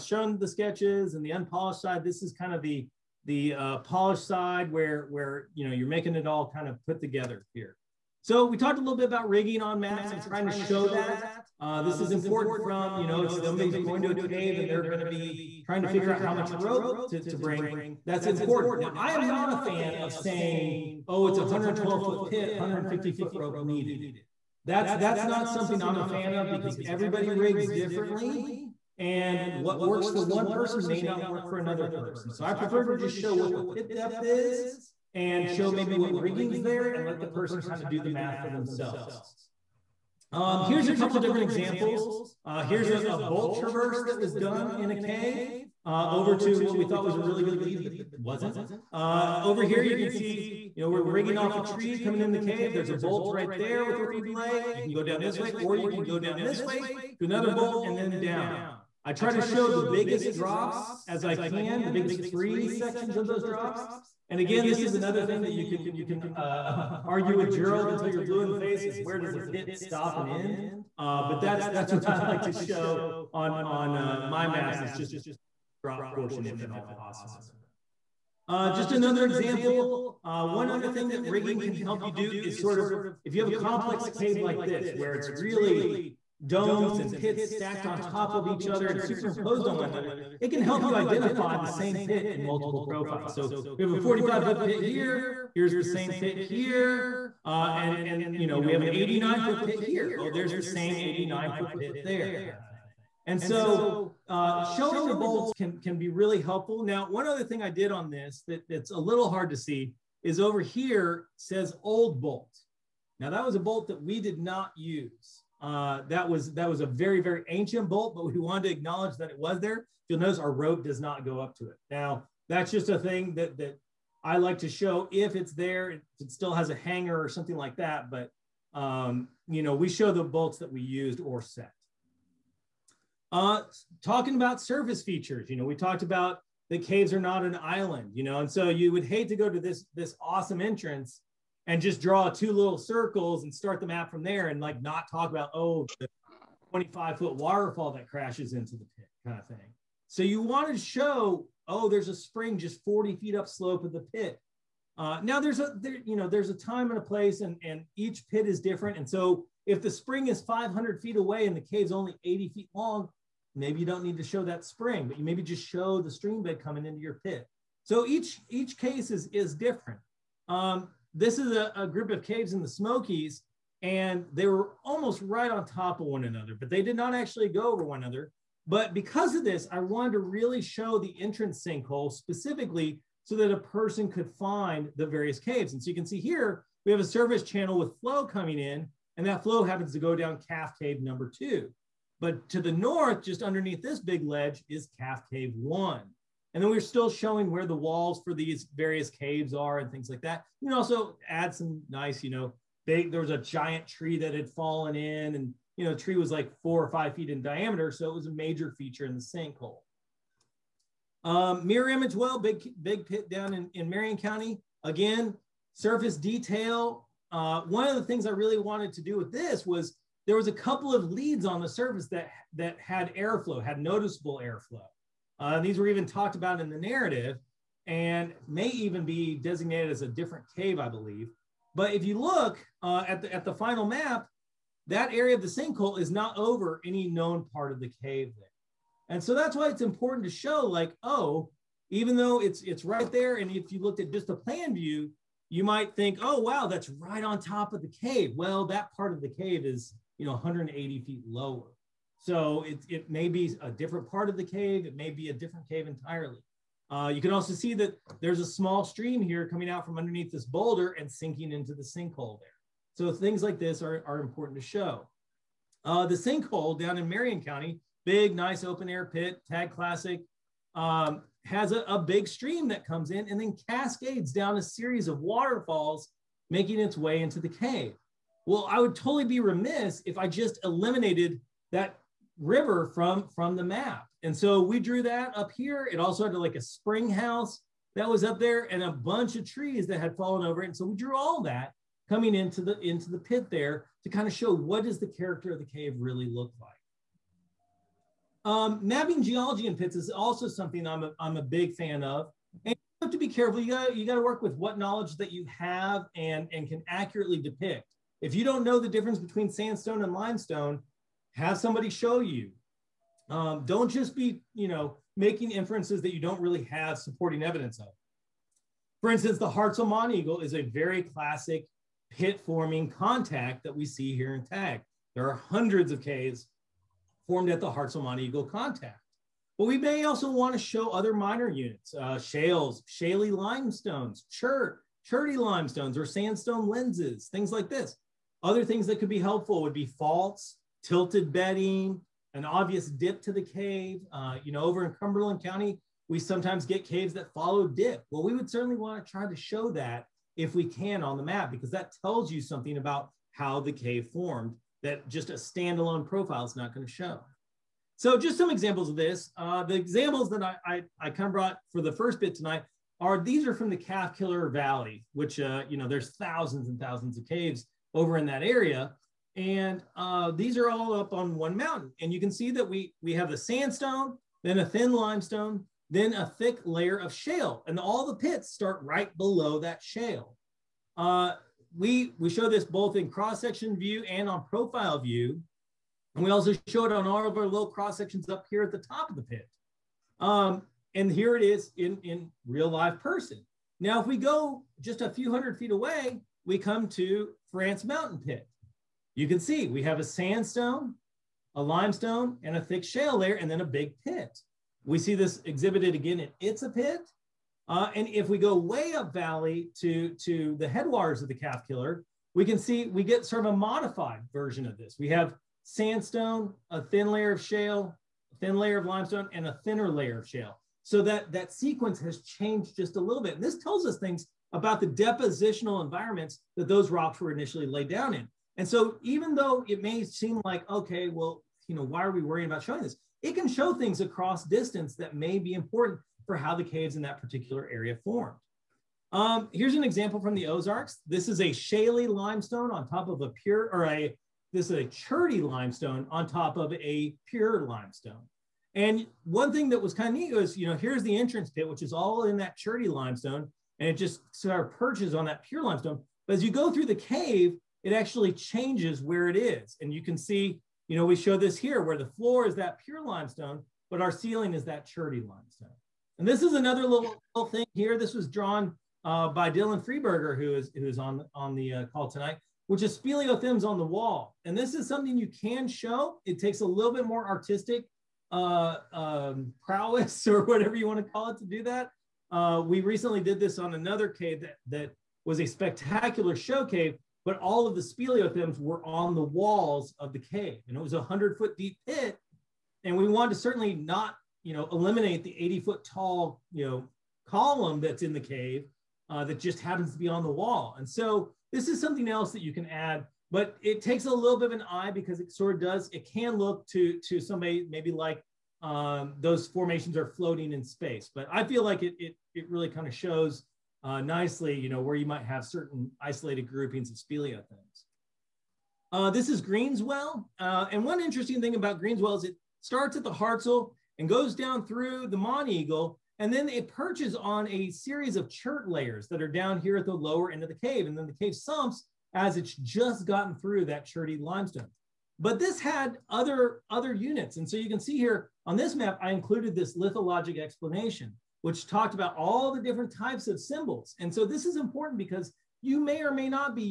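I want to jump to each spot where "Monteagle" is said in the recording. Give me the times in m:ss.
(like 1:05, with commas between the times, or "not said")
8:45.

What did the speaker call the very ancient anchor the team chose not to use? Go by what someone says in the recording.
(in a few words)
old bolt.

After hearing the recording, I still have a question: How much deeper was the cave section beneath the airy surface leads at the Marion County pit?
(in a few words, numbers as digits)
180 feet.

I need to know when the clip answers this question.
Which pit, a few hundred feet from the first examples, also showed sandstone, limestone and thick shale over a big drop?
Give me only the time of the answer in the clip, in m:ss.
6:37.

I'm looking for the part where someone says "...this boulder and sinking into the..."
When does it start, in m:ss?
4:20.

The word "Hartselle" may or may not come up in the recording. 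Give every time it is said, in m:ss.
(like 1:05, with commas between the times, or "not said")
5:19, 5:27, 8:43.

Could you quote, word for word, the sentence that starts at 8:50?
And then the cave sumps as it's just gotten through that cherty limestone.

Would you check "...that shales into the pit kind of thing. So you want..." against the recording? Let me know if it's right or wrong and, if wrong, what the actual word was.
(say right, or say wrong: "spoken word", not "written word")
wrong: "crashes", not "shales".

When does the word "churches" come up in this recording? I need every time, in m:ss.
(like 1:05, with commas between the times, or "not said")
not said.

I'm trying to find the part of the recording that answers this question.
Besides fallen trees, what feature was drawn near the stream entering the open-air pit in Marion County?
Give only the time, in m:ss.
4:46.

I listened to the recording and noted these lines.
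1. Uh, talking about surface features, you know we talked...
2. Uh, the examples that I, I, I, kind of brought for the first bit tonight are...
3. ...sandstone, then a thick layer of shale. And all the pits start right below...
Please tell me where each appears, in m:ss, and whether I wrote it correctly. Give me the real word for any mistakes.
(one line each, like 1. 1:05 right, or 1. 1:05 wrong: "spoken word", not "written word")
1. 2:13 right
2. 5:59 right
3. 6:14 wrong: "limestone", not "sandstone".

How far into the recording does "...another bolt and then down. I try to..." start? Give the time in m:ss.
0:57.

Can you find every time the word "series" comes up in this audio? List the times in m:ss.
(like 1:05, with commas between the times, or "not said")
4:34, 8:47.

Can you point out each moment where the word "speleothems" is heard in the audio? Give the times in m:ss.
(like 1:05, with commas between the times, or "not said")
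7:52, 8:07, 8:36.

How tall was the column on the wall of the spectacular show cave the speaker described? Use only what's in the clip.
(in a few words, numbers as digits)
80 foot.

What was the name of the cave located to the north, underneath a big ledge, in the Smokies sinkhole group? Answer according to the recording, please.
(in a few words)
Calf Cave 1.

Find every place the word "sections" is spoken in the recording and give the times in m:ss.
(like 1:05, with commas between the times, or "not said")
1:02, 6:23, 6:27.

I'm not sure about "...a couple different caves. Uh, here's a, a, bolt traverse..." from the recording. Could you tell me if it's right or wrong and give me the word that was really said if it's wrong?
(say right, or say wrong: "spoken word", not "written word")
wrong: "examples", not "caves".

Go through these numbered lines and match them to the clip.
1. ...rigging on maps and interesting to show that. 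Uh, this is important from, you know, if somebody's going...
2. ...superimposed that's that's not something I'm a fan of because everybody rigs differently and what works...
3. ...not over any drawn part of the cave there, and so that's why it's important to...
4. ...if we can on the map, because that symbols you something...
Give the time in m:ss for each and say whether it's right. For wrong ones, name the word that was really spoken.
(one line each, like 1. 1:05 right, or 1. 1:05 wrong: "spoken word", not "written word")
1. 0:09 wrong: "trying", not "interesting"
2. 0:23 wrong: "needed", not "superimposed"
3. 3:56 wrong: "known", not "drawn"
4. 5:50 wrong: "tells", not "symbols".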